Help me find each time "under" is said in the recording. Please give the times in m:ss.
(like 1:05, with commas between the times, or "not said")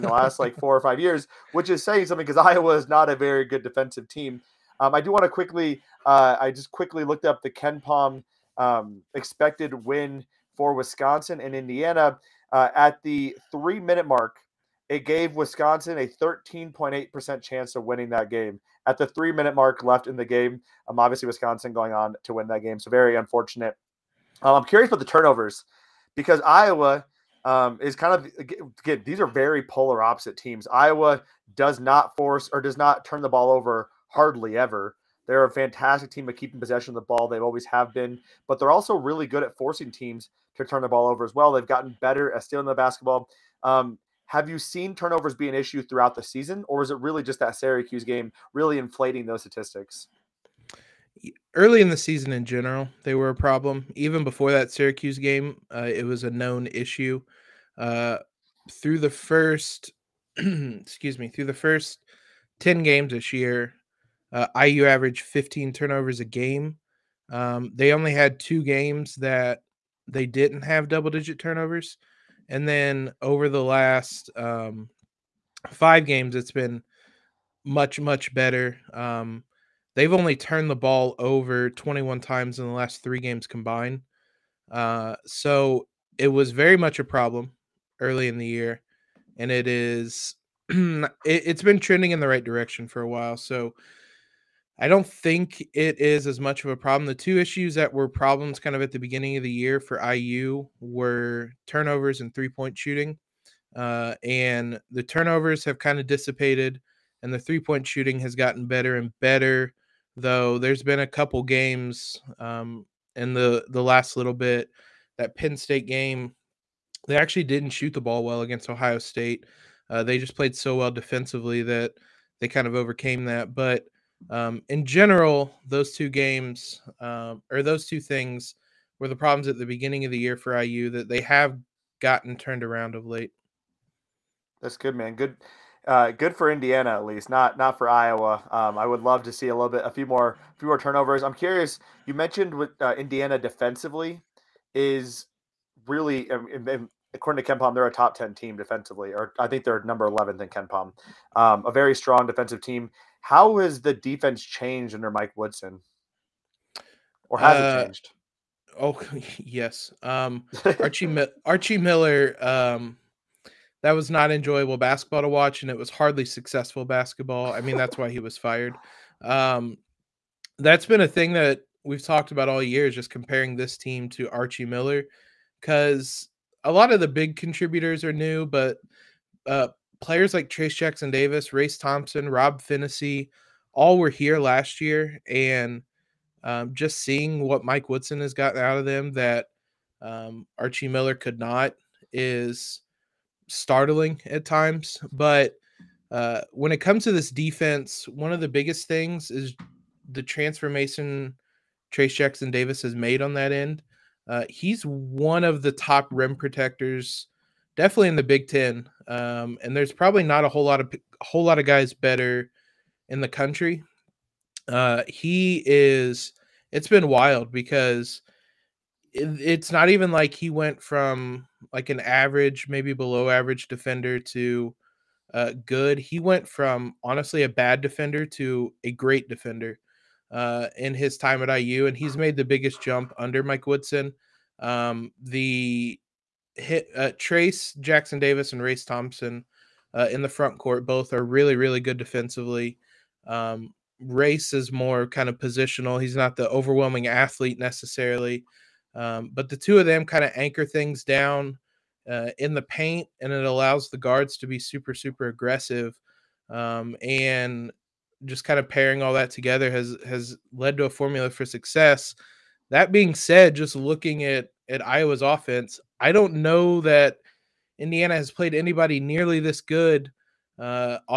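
2:34, 3:53.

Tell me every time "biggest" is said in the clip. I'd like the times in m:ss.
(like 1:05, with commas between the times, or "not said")
3:18, 3:52.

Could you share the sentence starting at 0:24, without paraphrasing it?
Um, I'm curious about the turnovers because Iowa um, is kind of again, these are very polar opposite teams.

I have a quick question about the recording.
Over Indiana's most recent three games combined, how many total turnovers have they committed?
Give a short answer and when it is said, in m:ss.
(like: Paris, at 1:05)
21, at 1:21.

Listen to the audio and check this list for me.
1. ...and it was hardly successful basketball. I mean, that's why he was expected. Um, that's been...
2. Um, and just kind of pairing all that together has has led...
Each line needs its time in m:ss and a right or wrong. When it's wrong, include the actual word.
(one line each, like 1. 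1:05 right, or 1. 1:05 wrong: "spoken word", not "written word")
1. 2:45 wrong: "fired", not "expected"
2. 4:16 right.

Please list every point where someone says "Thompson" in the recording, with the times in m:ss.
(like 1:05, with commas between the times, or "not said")
3:01, 3:58.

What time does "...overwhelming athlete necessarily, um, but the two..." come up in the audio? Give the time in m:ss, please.
4:06.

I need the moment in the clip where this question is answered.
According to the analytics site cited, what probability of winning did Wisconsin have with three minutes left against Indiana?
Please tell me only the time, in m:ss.
0:16.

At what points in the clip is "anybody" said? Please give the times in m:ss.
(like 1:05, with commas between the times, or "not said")
4:28.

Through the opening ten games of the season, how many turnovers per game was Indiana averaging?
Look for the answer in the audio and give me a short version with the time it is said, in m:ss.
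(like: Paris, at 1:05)
15, at 1:05.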